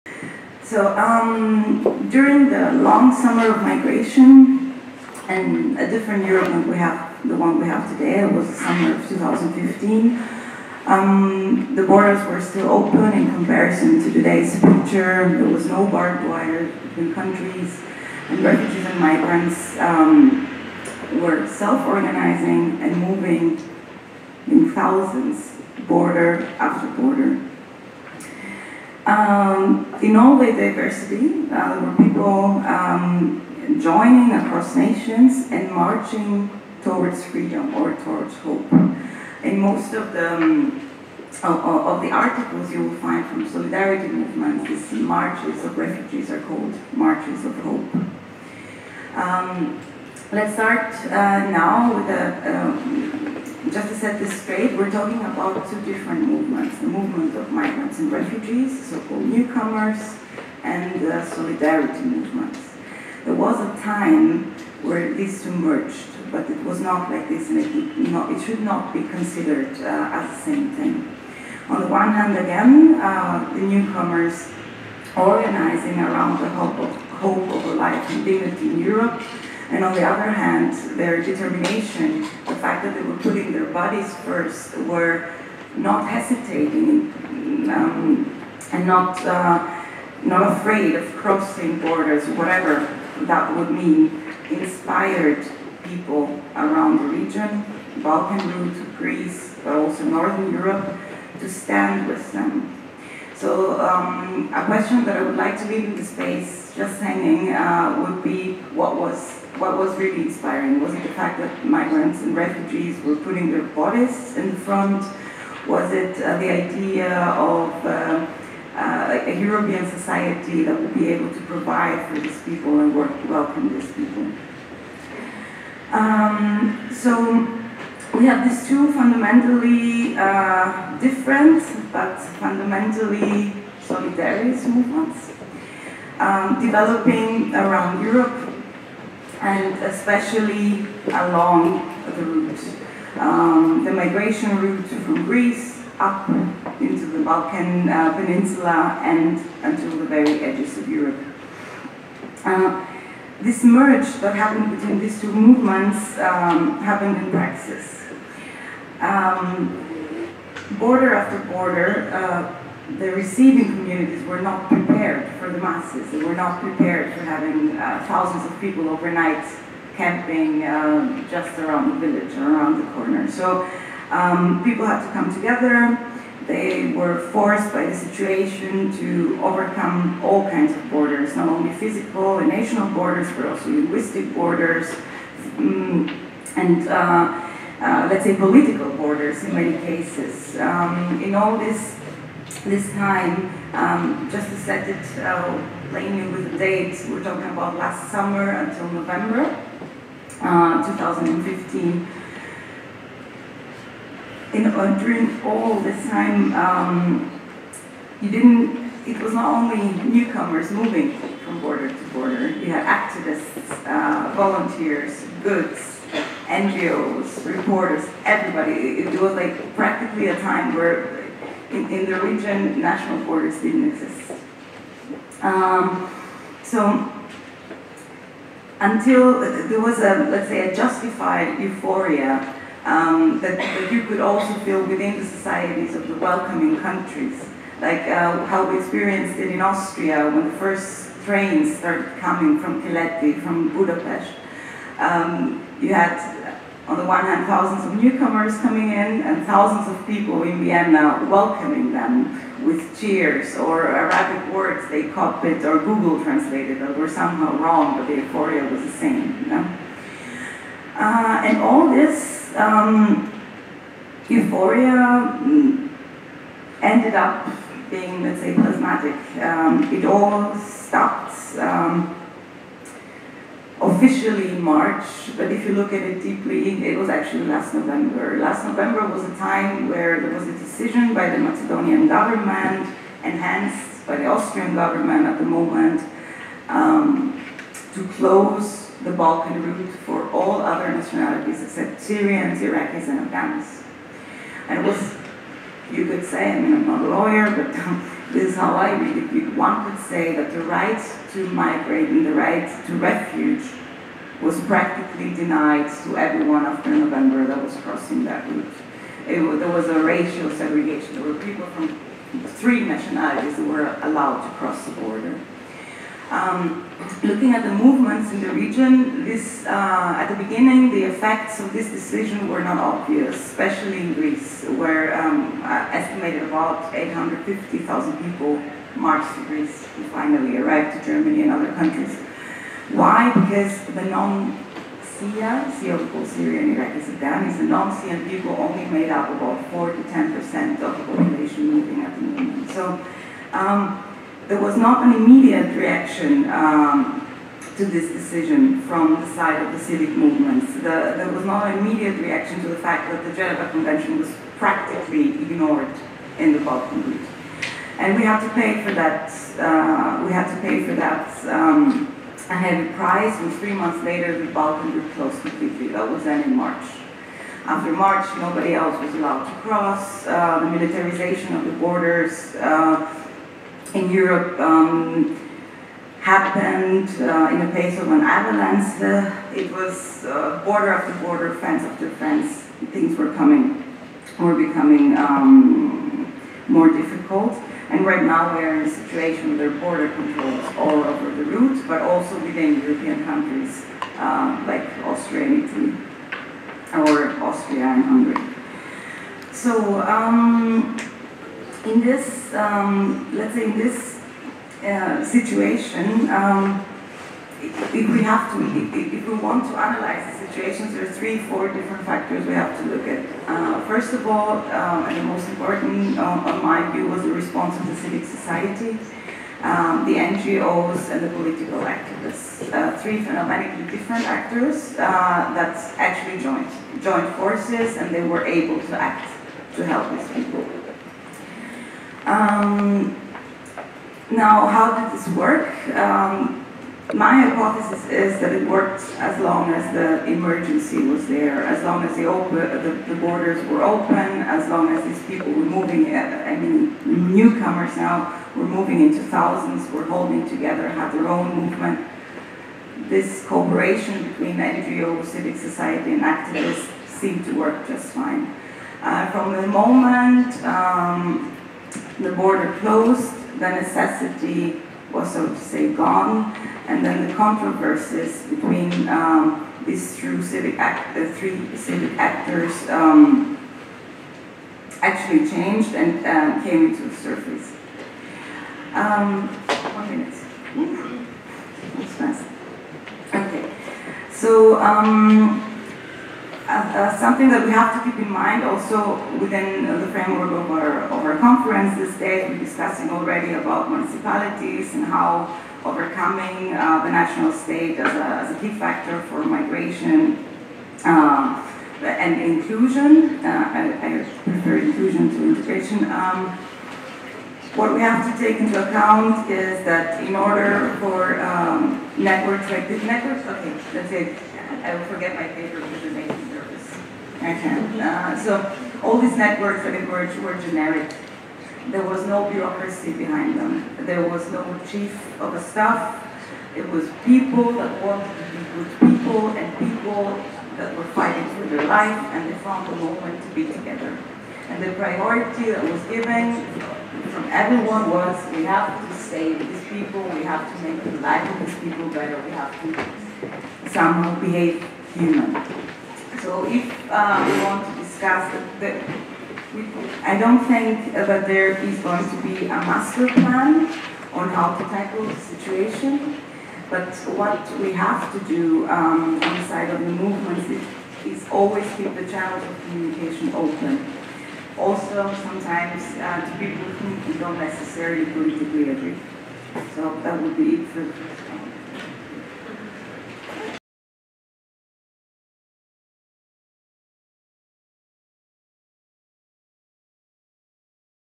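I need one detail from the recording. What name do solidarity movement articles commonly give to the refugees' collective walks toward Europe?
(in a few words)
marches of hope.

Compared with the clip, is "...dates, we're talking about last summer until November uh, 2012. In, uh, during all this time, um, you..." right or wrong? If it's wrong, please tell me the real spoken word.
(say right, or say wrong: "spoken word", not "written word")
wrong: "2015", not "2012".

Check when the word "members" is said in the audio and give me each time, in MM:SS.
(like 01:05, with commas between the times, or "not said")
not said.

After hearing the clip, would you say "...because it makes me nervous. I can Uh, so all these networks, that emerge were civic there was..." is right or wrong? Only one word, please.
wrong.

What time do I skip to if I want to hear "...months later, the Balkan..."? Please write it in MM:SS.
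06:03.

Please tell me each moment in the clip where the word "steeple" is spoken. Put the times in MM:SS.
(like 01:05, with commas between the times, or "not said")
not said.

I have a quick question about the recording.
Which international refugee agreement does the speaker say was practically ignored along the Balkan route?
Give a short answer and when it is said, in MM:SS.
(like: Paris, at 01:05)
Geneva Convention, at 05:53.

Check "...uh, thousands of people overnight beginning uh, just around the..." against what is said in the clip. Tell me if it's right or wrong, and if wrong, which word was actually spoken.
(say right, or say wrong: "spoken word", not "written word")
wrong: "camping", not "beginning".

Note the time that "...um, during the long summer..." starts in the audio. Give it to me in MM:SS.
00:00.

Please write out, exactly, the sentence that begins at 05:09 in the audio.
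It, there was a racial segregation.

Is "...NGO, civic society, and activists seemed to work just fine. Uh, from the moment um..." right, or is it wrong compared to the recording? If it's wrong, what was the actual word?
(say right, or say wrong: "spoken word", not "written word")
right.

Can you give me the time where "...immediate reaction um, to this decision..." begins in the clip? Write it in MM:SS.
05:45.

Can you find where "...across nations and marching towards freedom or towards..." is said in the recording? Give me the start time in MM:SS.
00:34.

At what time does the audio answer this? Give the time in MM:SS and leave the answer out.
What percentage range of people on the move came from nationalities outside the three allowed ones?
05:39.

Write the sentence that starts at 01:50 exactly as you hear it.
Was it the fact that migrants and refugees were putting their bodies in the front?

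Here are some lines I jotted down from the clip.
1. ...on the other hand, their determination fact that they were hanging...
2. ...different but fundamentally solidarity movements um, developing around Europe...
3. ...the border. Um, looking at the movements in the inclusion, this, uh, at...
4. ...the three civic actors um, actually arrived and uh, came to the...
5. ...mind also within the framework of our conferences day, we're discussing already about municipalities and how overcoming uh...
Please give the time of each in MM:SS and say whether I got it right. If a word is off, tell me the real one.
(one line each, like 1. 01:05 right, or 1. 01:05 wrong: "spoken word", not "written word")
1. 01:19 wrong: "putting", not "hanging"
2. 02:10 right
3. 05:14 wrong: "region", not "inclusion"
4. 07:51 wrong: "changed", not "arrived"
5. 08:08 right.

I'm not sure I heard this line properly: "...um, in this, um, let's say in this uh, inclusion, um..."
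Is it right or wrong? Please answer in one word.
wrong.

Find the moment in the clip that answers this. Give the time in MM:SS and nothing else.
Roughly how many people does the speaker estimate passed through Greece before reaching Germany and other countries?
05:26.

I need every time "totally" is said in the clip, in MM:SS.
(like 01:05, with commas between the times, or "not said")
not said.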